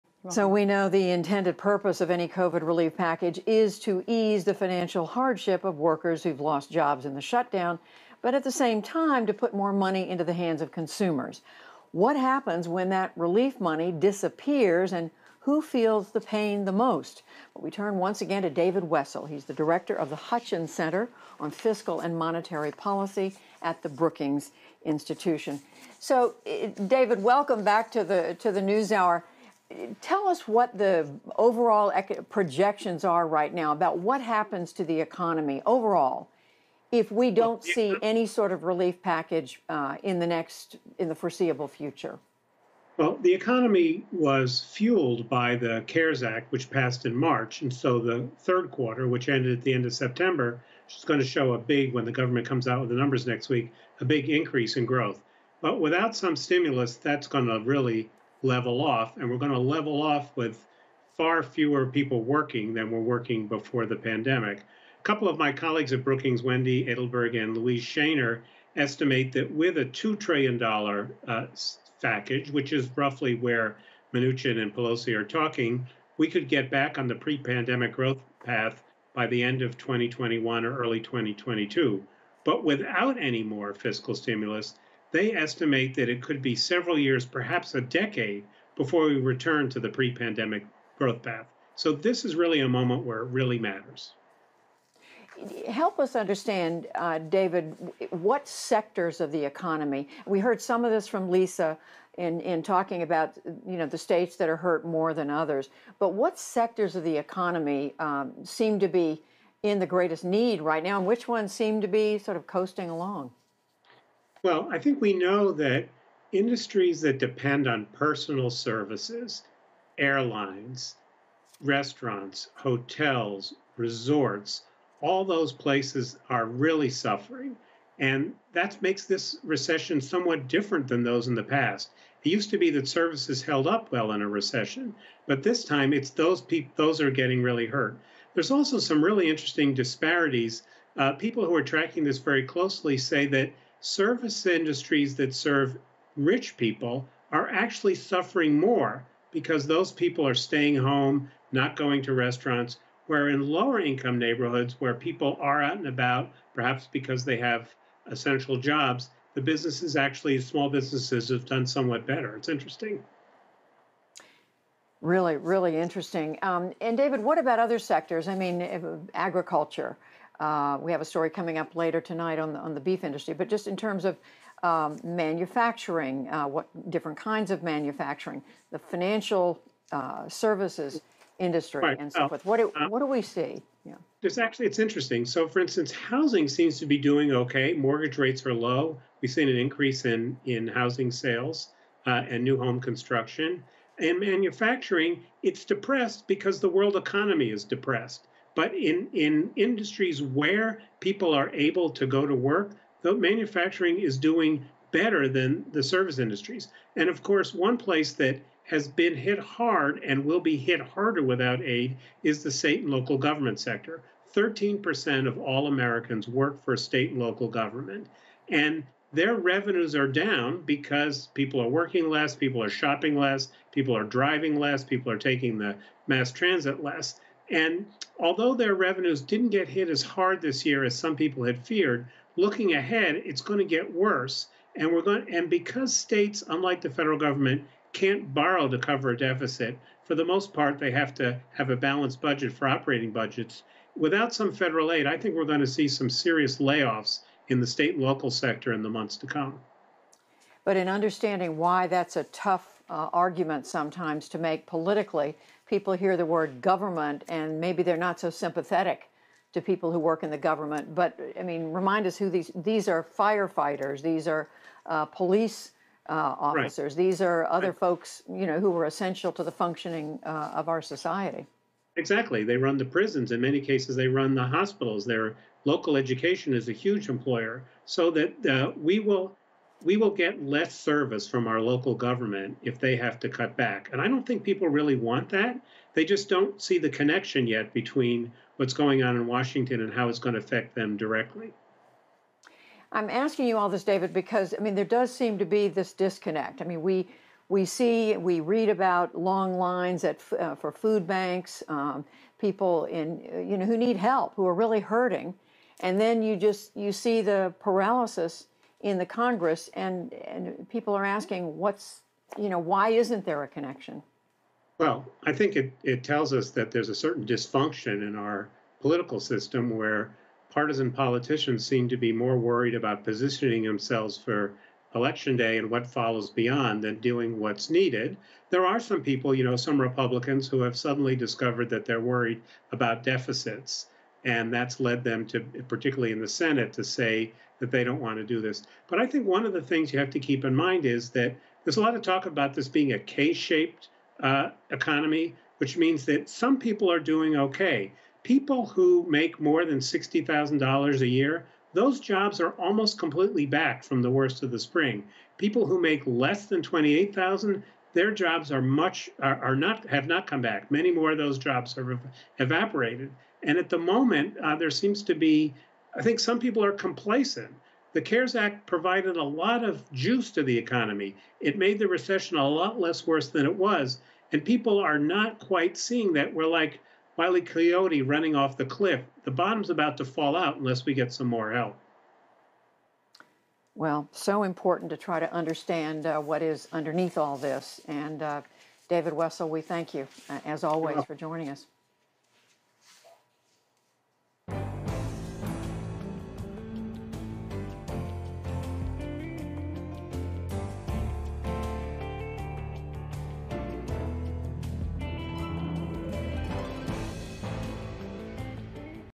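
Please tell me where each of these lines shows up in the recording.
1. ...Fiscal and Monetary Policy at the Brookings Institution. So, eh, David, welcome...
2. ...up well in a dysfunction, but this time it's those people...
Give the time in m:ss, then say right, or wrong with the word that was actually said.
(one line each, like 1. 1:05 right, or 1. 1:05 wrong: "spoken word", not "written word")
1. 0:21 right
2. 2:13 wrong: "recession", not "dysfunction".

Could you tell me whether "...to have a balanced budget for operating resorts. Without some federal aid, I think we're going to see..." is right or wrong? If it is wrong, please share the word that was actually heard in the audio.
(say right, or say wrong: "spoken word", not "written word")
wrong: "budgets", not "resorts".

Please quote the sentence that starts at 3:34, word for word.
13% of all Americans work for state and local government.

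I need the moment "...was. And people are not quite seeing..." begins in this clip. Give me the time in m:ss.
6:13.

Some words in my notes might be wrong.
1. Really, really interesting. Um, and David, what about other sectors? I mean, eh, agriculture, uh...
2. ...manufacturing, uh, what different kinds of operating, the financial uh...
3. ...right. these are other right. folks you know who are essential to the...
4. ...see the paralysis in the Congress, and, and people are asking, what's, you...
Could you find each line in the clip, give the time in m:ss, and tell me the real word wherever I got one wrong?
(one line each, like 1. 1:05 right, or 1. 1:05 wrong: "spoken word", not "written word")
1. 2:45 right
2. 2:55 wrong: "manufacturing", not "operating"
3. 4:26 right
4. 5:06 right.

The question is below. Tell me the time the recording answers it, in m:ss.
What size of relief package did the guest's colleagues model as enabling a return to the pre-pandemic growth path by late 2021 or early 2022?
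1:09.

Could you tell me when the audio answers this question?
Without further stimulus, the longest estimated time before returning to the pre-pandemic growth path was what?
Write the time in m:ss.
1:27.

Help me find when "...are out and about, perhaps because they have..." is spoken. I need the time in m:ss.
2:35.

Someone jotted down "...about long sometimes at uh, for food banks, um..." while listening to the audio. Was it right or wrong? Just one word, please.
wrong.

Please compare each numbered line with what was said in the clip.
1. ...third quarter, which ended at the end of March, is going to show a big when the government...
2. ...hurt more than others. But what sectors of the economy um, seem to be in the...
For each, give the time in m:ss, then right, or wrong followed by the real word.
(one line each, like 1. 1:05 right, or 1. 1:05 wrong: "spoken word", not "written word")
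1. 0:48 wrong: "September", not "March"
2. 1:44 right.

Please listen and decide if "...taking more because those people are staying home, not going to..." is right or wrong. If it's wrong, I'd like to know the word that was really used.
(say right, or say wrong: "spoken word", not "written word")
wrong: "suffering", not "taking".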